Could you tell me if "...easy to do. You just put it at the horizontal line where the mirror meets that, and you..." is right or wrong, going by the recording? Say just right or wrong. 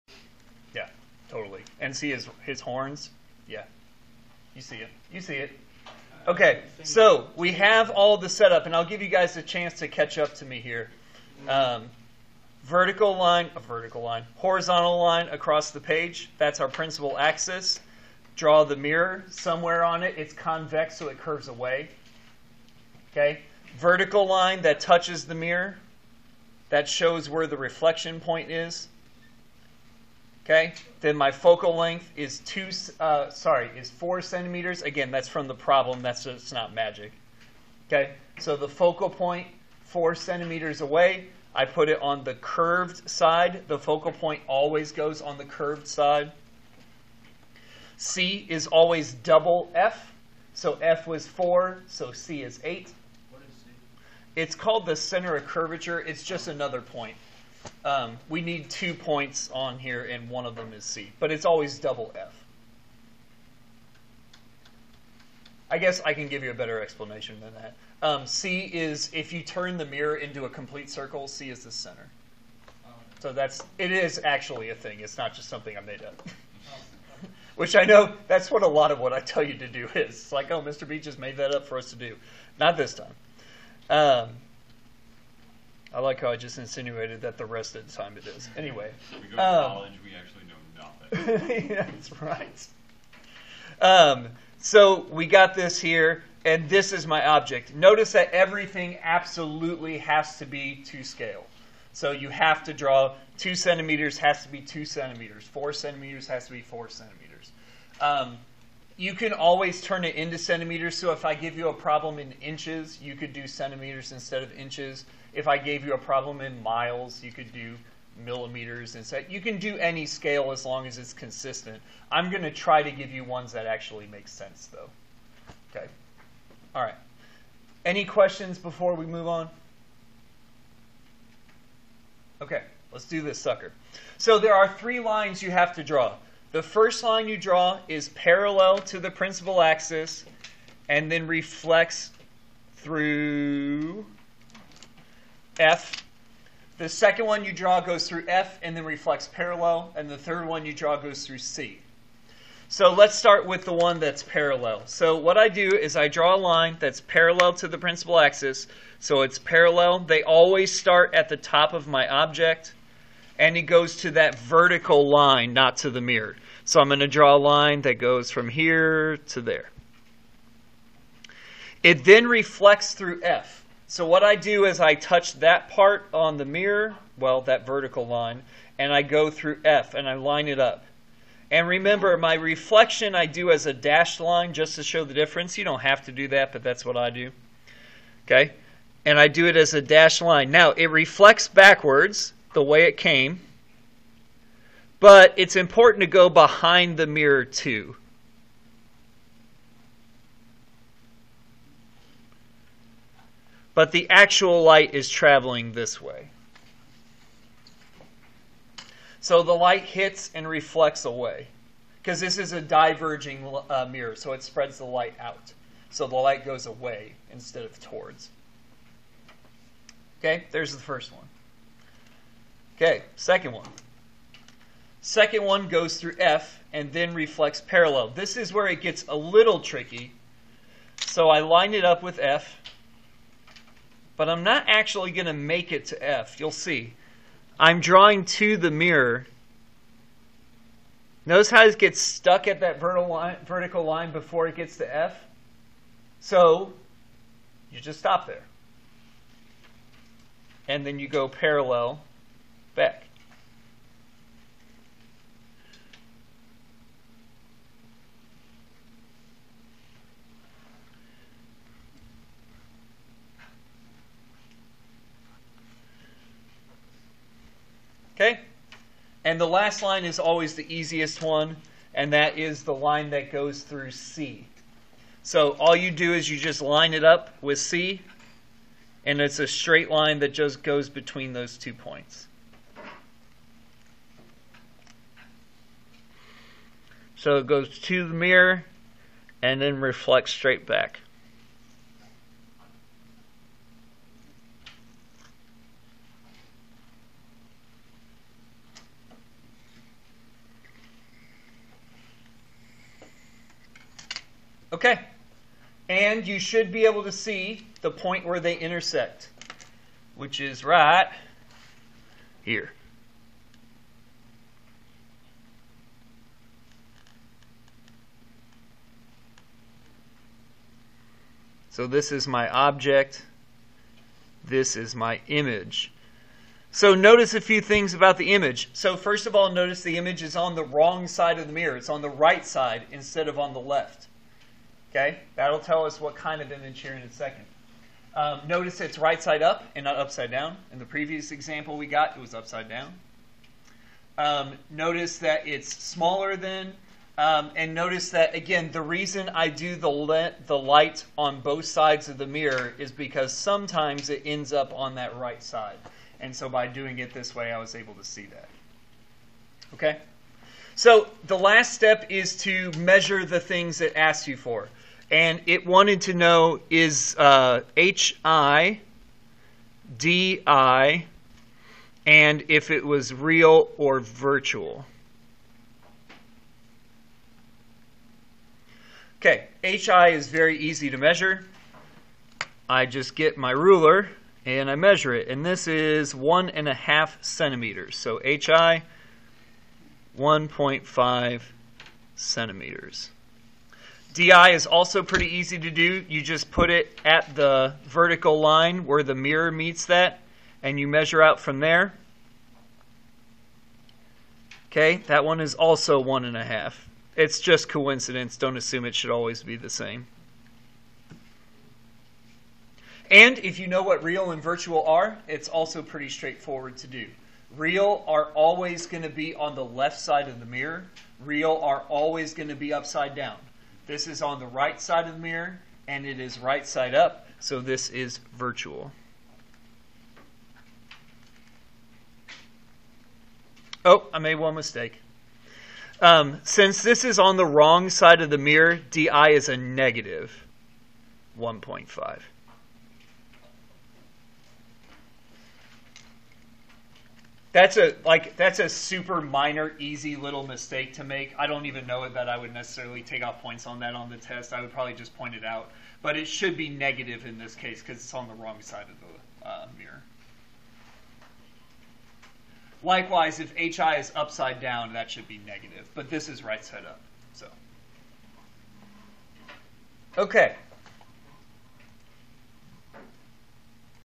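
wrong.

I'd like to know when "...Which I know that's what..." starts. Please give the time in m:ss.
1:17.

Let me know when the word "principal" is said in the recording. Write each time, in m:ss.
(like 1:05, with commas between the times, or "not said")
0:16, 2:19, 2:37.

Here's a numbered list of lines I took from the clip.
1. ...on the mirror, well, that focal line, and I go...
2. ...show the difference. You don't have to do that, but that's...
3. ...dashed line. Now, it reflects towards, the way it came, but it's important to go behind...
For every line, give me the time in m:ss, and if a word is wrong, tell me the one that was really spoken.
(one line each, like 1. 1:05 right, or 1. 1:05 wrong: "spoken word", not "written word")
1. 2:56 wrong: "vertical", not "focal"
2. 3:04 right
3. 3:09 wrong: "backwards", not "towards".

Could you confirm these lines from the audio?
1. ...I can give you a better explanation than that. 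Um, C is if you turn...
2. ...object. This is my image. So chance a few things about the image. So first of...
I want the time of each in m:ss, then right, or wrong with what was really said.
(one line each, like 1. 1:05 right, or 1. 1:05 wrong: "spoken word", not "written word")
1. 1:06 right
2. 5:22 wrong: "notice", not "chance".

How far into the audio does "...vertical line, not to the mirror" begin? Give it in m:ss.
2:44.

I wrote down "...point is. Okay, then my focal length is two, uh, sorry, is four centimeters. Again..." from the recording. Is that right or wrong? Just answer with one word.
right.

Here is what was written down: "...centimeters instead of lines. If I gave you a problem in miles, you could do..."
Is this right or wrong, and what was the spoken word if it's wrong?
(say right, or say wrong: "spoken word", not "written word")
wrong: "inches", not "lines".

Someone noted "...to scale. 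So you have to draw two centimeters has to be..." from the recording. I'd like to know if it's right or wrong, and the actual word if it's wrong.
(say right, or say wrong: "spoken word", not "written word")
right.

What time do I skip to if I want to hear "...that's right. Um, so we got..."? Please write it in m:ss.
1:31.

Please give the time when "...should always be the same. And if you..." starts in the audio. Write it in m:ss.
6:48.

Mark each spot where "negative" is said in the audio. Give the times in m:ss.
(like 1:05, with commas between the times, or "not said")
7:19, 7:36, 7:45.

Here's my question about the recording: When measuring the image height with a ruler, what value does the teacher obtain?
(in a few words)
1.5 centimeters.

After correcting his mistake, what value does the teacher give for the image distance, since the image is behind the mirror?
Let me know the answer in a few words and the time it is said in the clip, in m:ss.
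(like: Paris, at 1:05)
-1.5, at 7:19.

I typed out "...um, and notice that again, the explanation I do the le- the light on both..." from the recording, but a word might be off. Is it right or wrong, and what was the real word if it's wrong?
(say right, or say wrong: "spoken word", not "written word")
wrong: "reason", not "explanation".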